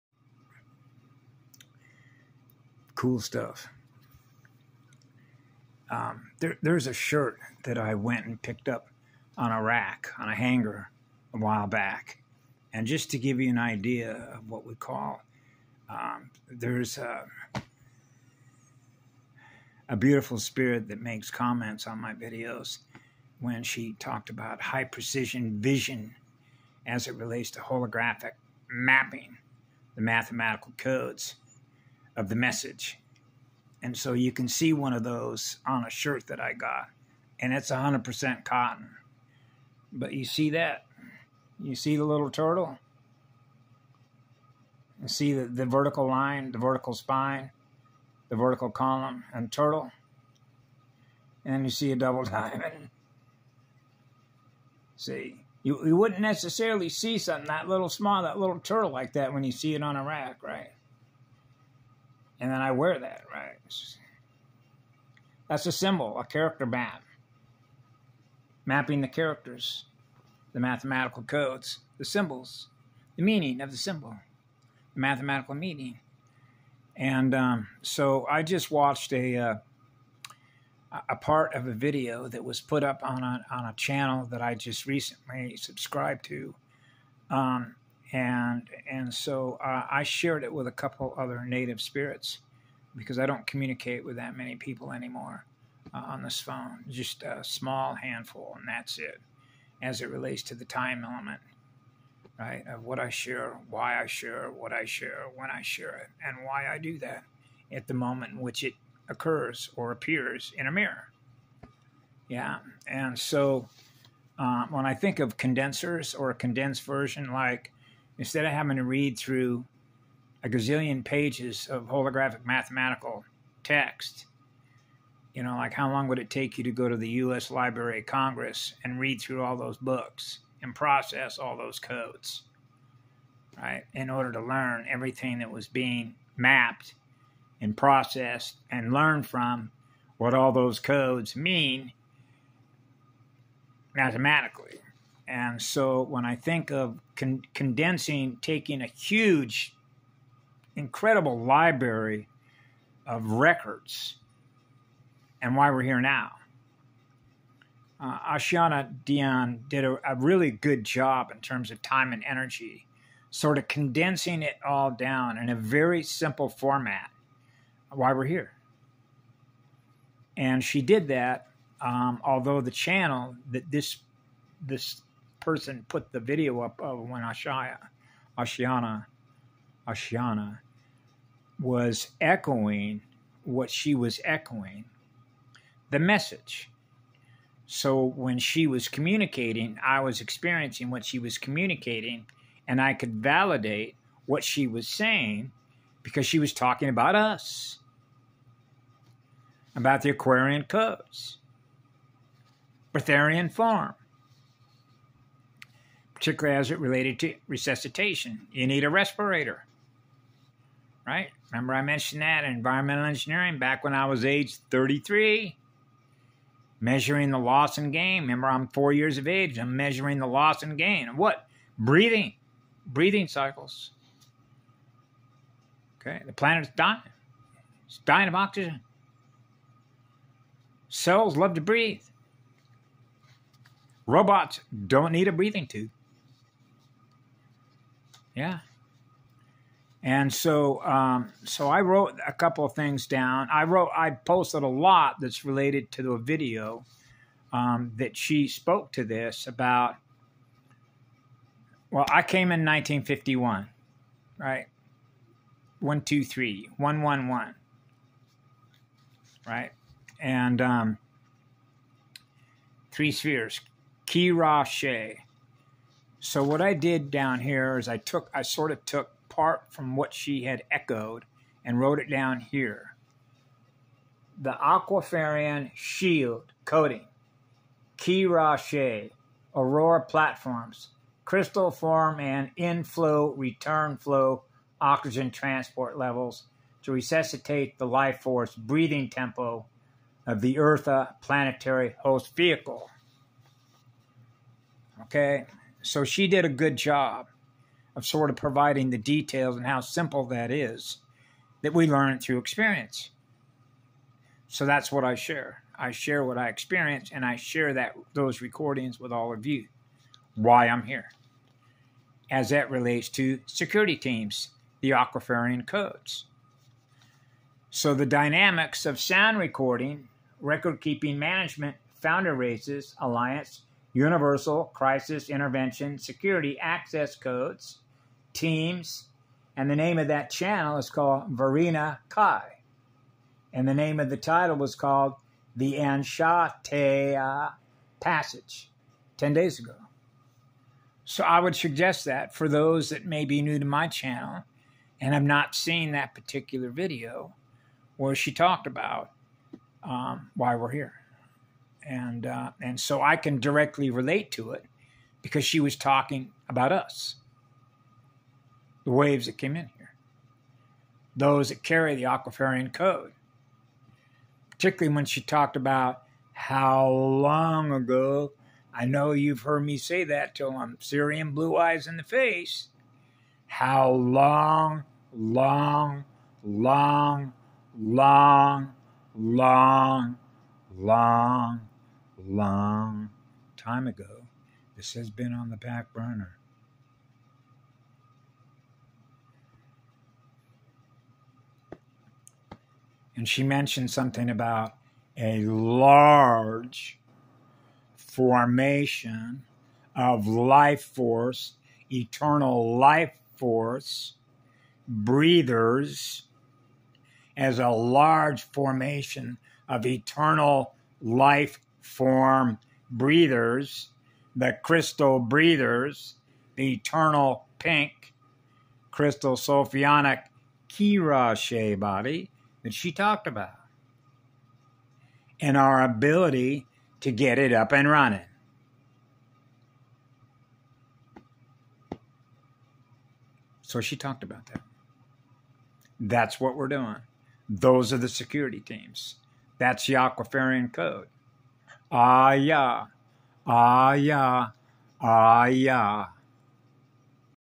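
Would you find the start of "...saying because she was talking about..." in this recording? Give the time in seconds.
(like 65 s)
194 s.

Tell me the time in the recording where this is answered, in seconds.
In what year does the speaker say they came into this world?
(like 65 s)
252 s.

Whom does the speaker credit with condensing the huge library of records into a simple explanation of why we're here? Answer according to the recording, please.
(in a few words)
Ashayana Deane.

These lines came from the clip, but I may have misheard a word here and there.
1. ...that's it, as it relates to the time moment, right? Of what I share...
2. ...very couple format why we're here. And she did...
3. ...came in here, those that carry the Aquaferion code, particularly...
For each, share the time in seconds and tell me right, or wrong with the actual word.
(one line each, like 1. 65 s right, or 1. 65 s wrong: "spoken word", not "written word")
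1. 98 s wrong: "element", not "moment"
2. 165 s wrong: "simple", not "couple"
3. 359 s right.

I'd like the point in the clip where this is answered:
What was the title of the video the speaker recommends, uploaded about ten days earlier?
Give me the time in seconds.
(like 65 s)
335 s.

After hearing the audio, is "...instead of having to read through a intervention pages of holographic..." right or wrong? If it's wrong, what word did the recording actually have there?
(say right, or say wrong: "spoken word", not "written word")
wrong: "gazillion", not "intervention".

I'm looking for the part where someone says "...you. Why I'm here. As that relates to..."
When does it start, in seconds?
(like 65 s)
309 s.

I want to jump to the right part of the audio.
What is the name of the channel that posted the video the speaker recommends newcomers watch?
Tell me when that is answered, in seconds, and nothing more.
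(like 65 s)
331 s.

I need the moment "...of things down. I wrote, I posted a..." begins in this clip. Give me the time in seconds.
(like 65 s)
242 s.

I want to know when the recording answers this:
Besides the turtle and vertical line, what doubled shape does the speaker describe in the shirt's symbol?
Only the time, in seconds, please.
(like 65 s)
52 s.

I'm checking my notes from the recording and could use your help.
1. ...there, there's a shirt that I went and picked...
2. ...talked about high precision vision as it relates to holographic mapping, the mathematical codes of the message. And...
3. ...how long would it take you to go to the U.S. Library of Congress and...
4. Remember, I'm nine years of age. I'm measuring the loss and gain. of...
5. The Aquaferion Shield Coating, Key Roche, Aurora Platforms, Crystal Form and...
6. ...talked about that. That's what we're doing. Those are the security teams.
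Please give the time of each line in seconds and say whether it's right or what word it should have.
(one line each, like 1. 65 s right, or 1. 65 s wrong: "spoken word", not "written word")
1. 6 s right
2. 23 s right
3. 125 s right
4. 218 s wrong: "four", not "nine"
5. 274 s right
6. 433 s right.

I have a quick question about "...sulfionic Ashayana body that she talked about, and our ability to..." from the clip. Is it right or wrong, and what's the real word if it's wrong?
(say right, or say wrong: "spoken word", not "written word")
wrong: "Kirashe", not "Ashayana".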